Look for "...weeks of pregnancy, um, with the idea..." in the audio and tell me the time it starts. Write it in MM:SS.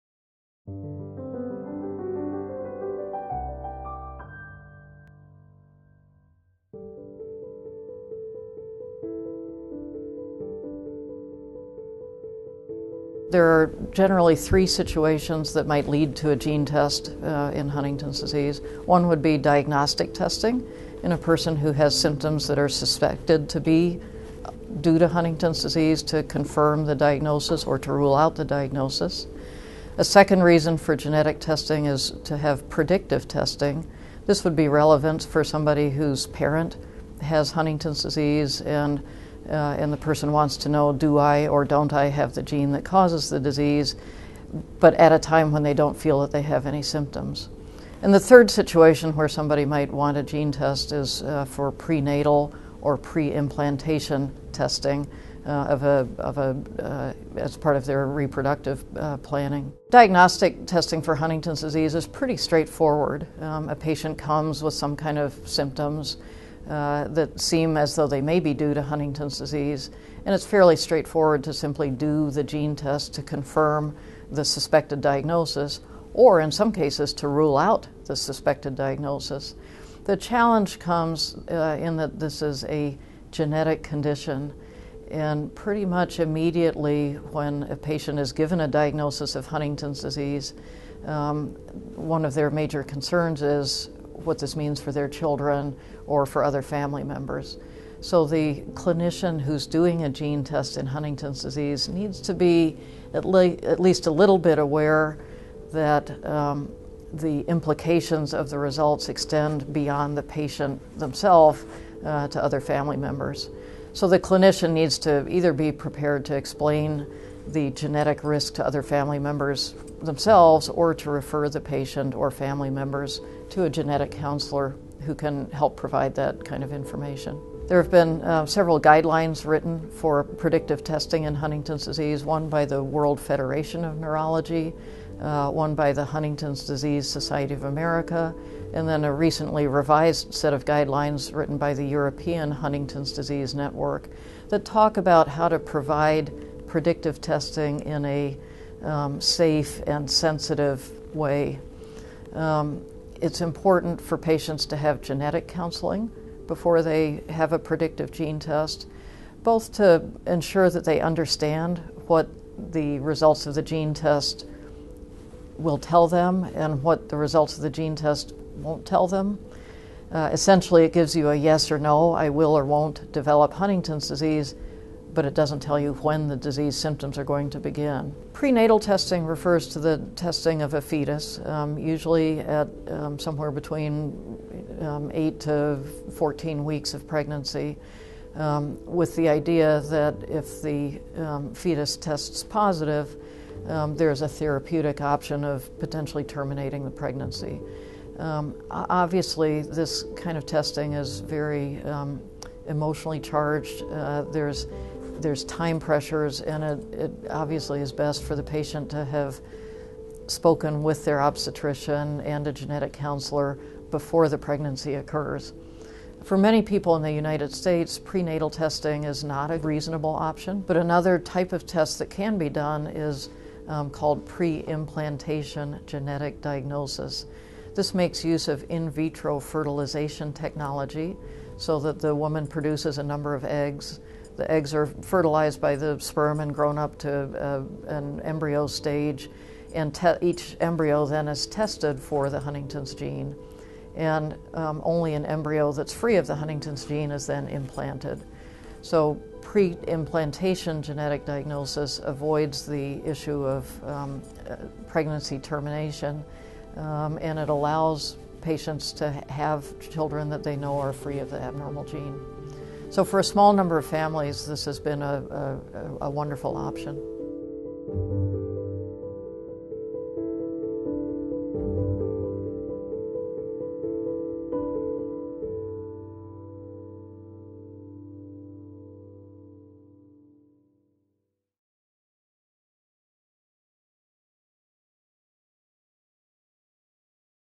03:06.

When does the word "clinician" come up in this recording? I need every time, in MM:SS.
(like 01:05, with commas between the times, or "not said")
01:38, 01:54.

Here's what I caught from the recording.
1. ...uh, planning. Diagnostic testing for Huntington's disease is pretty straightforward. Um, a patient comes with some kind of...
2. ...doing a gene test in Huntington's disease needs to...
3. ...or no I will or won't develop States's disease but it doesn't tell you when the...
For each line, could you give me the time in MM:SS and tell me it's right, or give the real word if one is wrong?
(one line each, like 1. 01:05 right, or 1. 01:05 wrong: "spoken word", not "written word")
1. 00:58 right
2. 01:39 right
3. 02:51 wrong: "Huntington", not "States".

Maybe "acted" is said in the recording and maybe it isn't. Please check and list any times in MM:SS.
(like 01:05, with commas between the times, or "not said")
not said.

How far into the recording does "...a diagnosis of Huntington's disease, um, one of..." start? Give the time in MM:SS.
01:28.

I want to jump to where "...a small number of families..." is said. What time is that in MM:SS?
04:23.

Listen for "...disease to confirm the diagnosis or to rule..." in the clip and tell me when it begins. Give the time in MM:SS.
00:25.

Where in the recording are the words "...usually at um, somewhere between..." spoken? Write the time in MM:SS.
03:01.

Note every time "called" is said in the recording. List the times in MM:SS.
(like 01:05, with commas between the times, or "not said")
03:43.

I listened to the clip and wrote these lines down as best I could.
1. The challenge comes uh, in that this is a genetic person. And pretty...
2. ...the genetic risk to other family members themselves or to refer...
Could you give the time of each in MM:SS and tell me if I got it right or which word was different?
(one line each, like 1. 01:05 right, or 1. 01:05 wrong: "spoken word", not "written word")
1. 01:20 wrong: "condition", not "person"
2. 01:57 right.